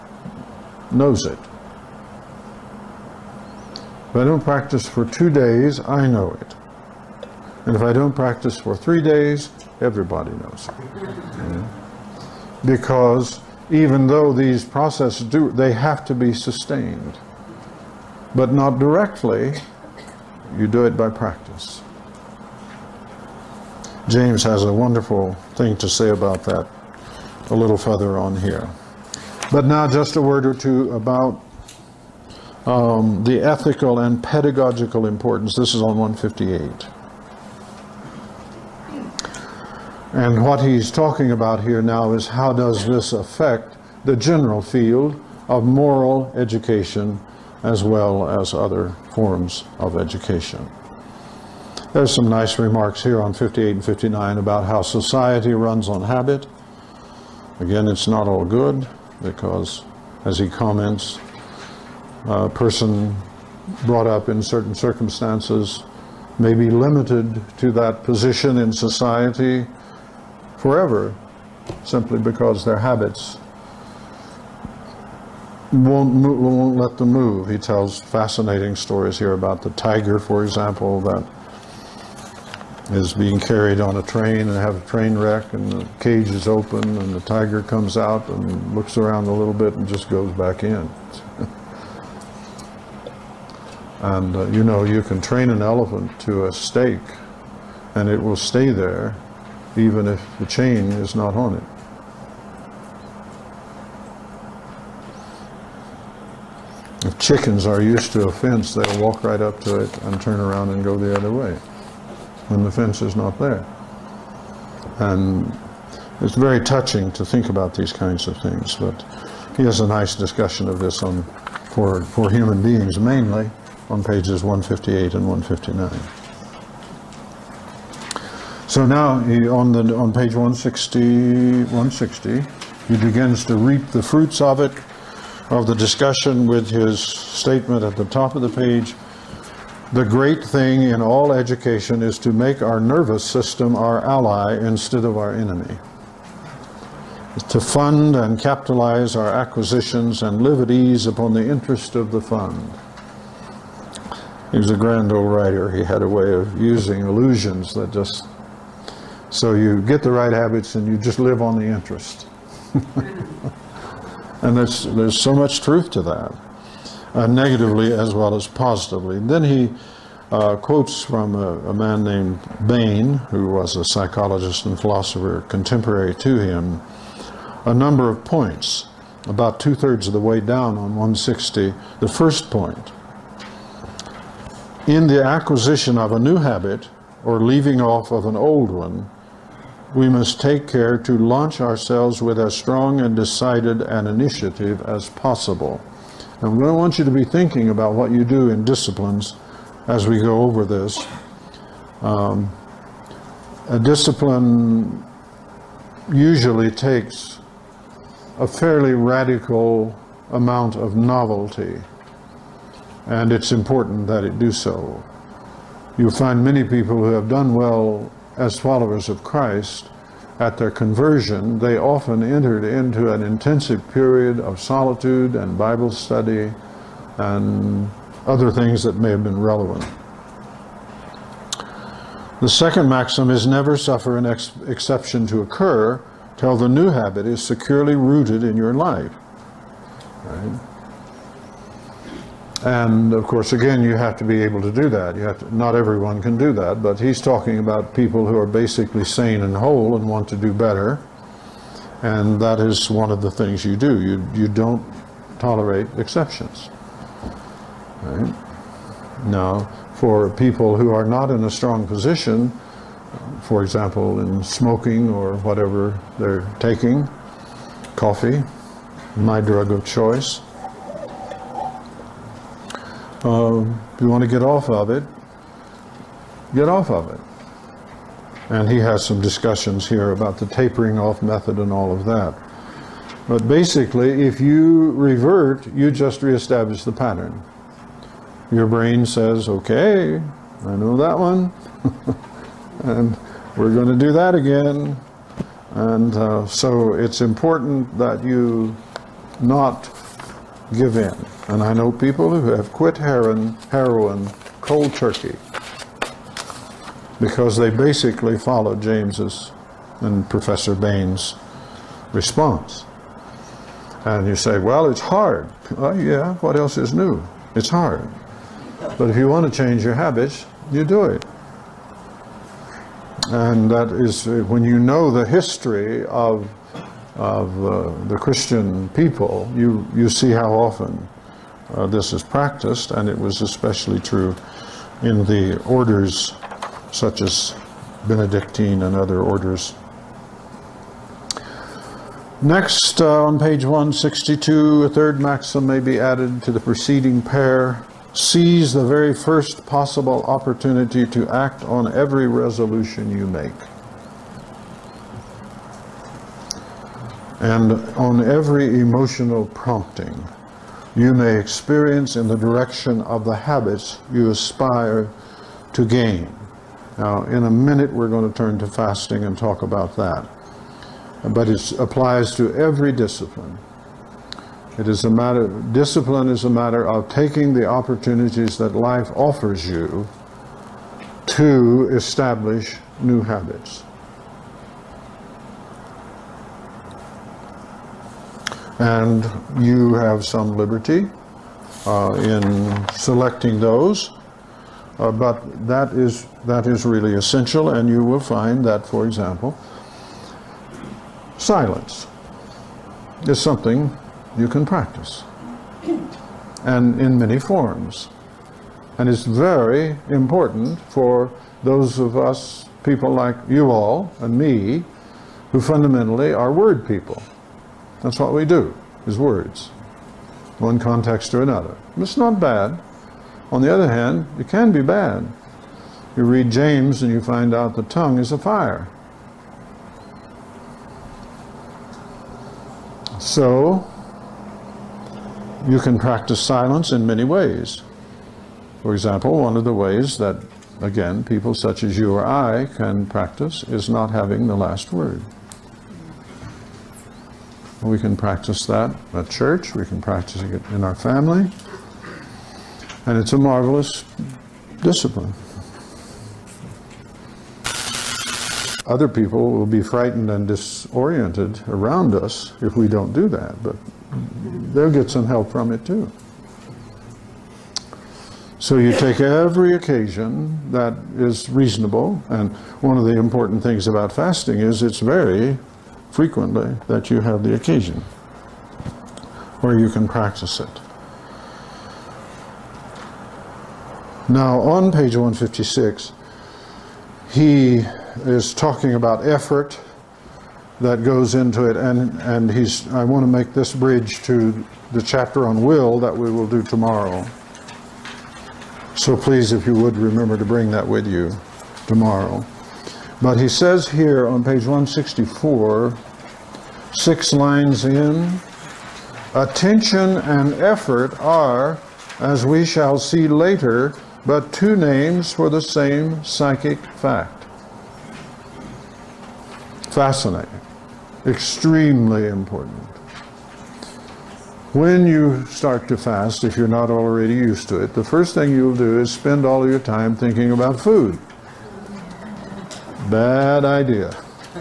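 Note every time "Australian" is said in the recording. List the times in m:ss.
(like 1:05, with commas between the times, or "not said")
not said.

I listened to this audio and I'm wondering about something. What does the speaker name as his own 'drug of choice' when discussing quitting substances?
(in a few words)
Coffee.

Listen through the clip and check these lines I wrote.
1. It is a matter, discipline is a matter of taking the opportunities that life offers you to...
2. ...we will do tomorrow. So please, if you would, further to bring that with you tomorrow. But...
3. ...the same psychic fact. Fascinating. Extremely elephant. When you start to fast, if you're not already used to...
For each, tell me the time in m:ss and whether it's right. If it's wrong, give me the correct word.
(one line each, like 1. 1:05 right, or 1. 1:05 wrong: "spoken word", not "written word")
1. 6:14 right
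2. 8:16 wrong: "remember", not "further"
3. 8:35 wrong: "important", not "elephant".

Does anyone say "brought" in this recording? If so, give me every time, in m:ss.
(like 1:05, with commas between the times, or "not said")
1:03.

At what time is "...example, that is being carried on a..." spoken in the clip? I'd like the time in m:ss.
1:20.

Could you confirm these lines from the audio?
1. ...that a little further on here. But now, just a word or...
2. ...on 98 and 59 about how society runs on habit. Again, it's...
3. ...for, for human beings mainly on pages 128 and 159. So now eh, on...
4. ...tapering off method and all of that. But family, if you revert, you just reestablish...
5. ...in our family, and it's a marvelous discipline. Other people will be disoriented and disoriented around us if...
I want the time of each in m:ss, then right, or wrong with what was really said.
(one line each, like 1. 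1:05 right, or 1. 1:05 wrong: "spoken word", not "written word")
1. 0:26 right
2. 0:53 wrong: "58", not "98"
3. 2:01 wrong: "158", not "128"
4. 4:40 wrong: "basically", not "family"
5. 7:30 wrong: "frightened", not "disoriented".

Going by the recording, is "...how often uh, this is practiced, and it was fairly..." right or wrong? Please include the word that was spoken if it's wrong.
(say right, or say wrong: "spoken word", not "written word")
wrong: "especially", not "fairly".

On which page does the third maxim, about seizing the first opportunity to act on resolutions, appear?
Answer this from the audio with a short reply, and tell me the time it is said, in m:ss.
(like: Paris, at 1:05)
162, at 5:43.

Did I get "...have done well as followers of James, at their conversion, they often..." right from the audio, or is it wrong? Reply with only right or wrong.
wrong.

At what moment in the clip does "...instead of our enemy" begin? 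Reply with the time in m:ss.
2:24.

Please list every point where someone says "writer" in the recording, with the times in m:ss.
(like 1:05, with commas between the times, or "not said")
2:35.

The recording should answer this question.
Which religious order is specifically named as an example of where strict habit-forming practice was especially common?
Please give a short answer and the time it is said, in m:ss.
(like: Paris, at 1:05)
Benedictine, at 5:38.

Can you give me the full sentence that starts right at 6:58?
That's what we do, is words, one context to another.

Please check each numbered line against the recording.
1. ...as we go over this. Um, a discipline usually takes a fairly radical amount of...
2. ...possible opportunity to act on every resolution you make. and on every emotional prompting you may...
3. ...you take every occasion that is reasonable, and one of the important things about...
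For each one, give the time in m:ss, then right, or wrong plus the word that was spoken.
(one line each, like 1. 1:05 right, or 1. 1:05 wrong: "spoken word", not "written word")
1. 3:19 right
2. 5:49 right
3. 7:48 right.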